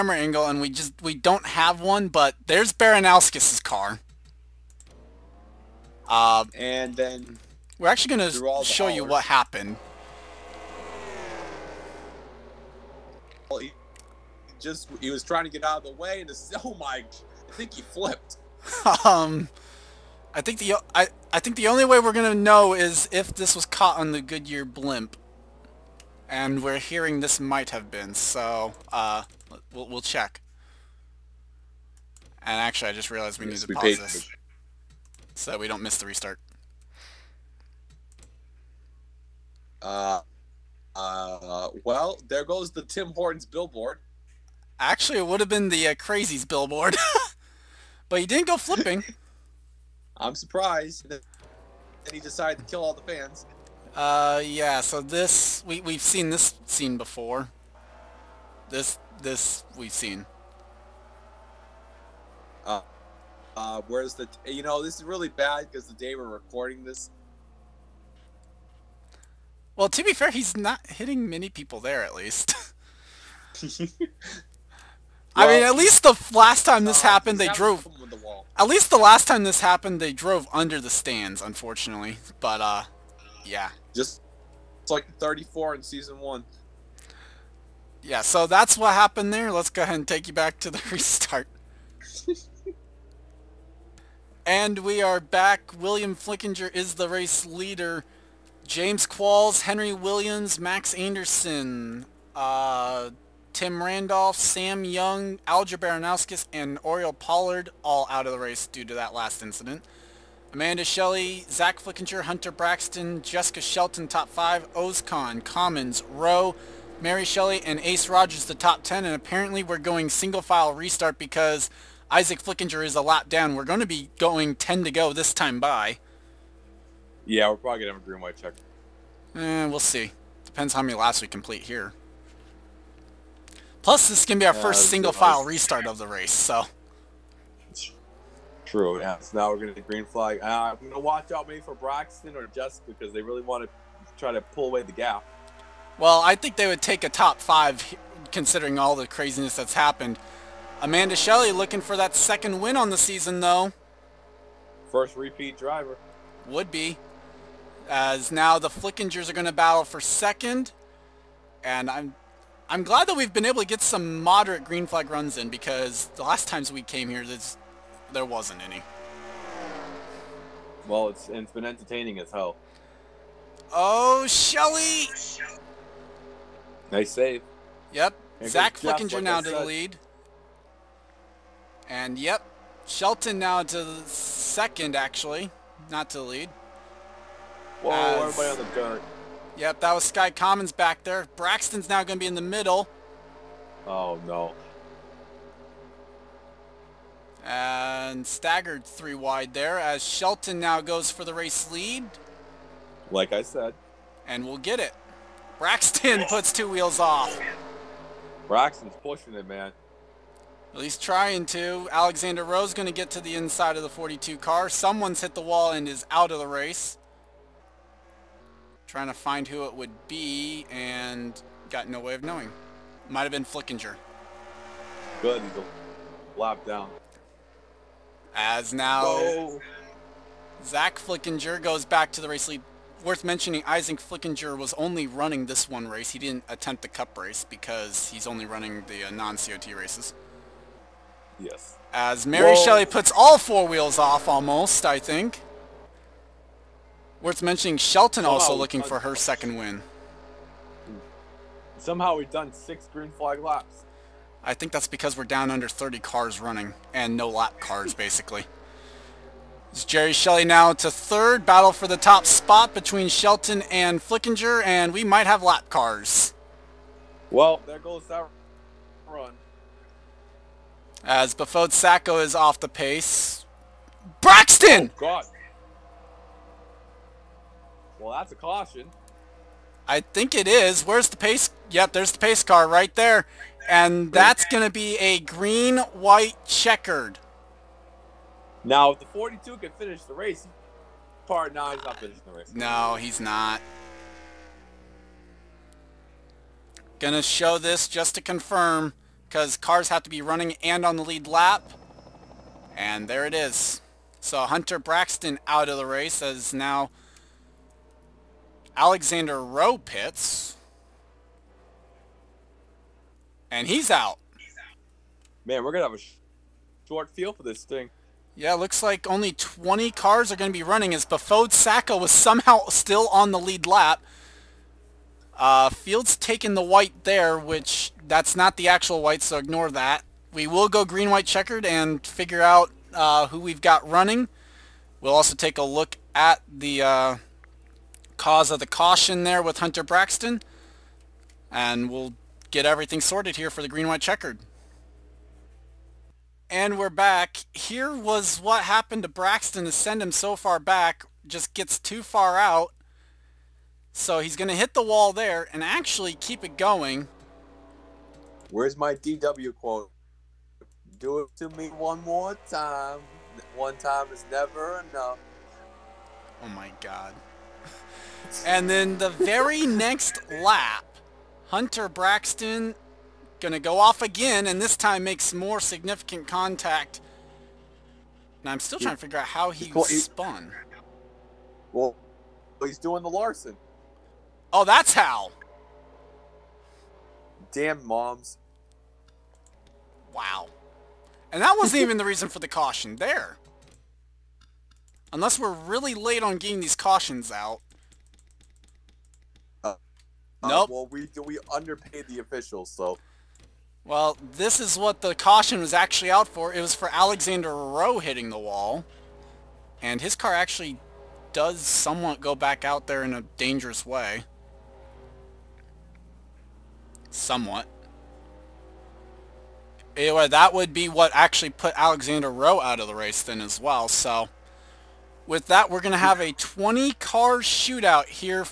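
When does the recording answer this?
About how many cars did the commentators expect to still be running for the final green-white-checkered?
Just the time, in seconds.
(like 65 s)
319 s.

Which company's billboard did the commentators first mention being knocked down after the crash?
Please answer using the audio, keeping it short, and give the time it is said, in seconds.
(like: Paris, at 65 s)
Tim Hortons, at 42 s.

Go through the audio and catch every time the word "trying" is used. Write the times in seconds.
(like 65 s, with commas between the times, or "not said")
15 s, 211 s, 218 s, 378 s.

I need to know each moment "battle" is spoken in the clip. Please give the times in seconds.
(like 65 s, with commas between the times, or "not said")
159 s, 261 s.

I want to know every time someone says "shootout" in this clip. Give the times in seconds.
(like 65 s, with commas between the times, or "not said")
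427 s.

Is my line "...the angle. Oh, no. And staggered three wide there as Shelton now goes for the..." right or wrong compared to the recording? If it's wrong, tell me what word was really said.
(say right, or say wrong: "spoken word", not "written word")
wrong: "middle", not "angle".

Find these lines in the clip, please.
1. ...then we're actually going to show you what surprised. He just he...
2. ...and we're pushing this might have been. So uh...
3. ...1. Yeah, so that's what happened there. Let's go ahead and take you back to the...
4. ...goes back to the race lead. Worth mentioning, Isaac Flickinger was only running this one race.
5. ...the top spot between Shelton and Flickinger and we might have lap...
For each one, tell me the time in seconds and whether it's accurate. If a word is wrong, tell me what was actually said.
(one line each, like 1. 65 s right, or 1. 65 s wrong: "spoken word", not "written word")
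1. 6 s wrong: "happened", not "surprised"
2. 26 s wrong: "hearing", not "pushing"
3. 86 s right
4. 231 s right
5. 261 s right.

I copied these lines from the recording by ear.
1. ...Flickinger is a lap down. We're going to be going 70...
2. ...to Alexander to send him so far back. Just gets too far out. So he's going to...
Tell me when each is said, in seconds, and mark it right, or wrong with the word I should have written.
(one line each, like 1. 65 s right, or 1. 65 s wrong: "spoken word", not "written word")
1. 122 s wrong: "10", not "70"
2. 349 s wrong: "Braxton", not "Alexander".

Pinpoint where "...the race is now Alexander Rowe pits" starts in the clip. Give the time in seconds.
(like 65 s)
305 s.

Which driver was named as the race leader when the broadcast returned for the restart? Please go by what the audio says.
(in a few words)
William Flickinger.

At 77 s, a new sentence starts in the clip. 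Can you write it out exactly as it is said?
The at least the last time this happened, they drove under the stands, unfortunately.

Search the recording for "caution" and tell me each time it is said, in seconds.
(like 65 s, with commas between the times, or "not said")
278 s, 338 s, 392 s, 396 s, 405 s.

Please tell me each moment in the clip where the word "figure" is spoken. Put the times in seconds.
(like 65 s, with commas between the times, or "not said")
332 s, 379 s.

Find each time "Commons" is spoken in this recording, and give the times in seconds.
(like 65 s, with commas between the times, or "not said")
115 s, 190 s.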